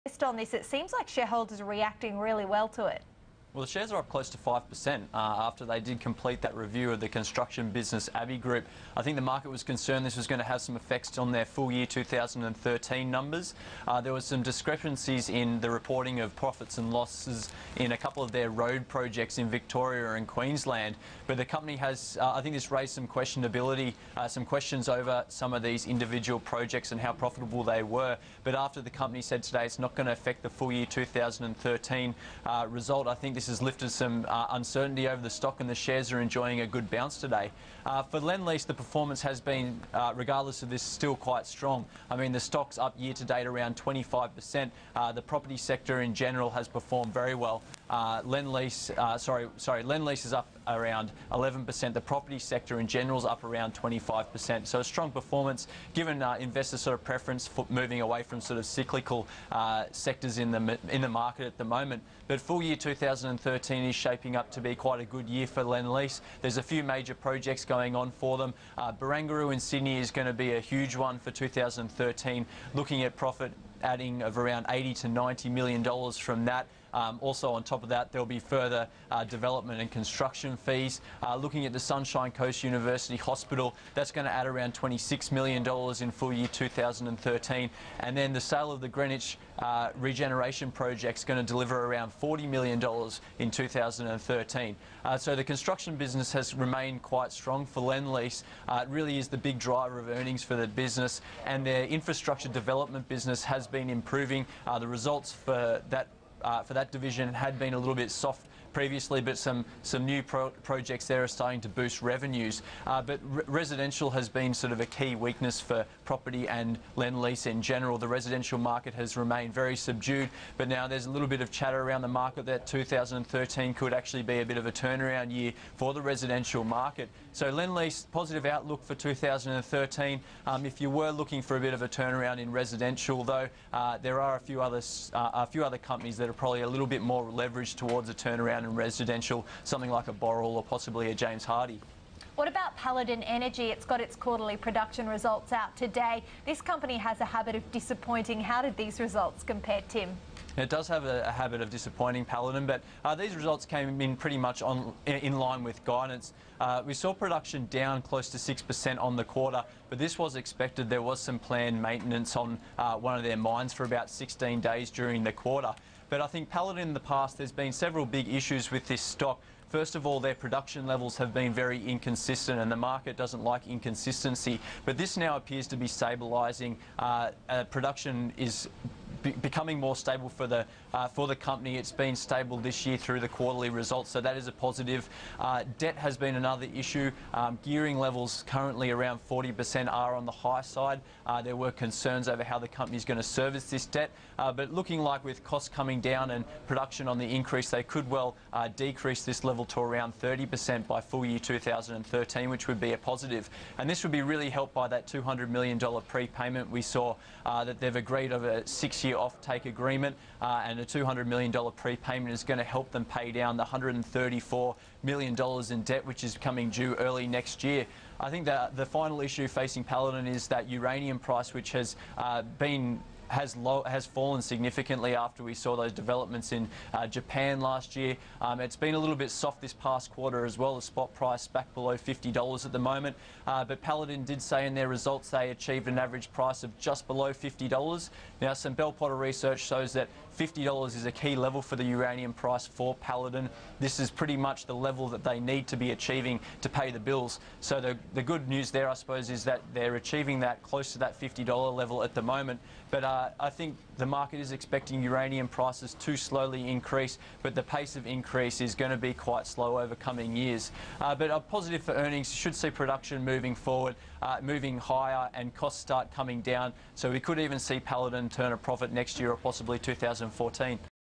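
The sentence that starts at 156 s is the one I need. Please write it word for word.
Uh, we saw production down close to 6% on the quarter, but this was expected.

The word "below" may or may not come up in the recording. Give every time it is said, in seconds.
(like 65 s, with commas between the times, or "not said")
231 s, 237 s.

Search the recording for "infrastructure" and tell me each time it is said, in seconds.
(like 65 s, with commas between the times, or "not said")
101 s.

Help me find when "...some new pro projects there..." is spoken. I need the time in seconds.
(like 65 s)
109 s.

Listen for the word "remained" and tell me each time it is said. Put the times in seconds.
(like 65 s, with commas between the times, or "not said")
96 s, 119 s.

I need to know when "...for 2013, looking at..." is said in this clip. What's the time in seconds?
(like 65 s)
71 s.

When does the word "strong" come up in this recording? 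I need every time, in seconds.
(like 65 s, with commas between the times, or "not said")
41 s, 54 s, 97 s.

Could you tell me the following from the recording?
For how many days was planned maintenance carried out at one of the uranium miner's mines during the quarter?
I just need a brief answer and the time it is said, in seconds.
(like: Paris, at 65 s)
16 days, at 164 s.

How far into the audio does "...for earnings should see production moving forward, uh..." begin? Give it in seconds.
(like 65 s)
261 s.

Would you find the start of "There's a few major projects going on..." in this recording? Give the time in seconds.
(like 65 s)
66 s.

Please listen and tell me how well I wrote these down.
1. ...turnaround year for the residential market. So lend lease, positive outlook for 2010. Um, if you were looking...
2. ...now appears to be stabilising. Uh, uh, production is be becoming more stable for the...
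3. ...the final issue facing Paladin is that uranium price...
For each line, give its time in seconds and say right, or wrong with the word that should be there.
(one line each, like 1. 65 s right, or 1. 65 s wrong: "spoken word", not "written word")
1. 124 s wrong: "2013", not "2010"
2. 175 s right
3. 218 s right.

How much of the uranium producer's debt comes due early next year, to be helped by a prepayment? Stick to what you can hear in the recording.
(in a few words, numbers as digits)
$134 million.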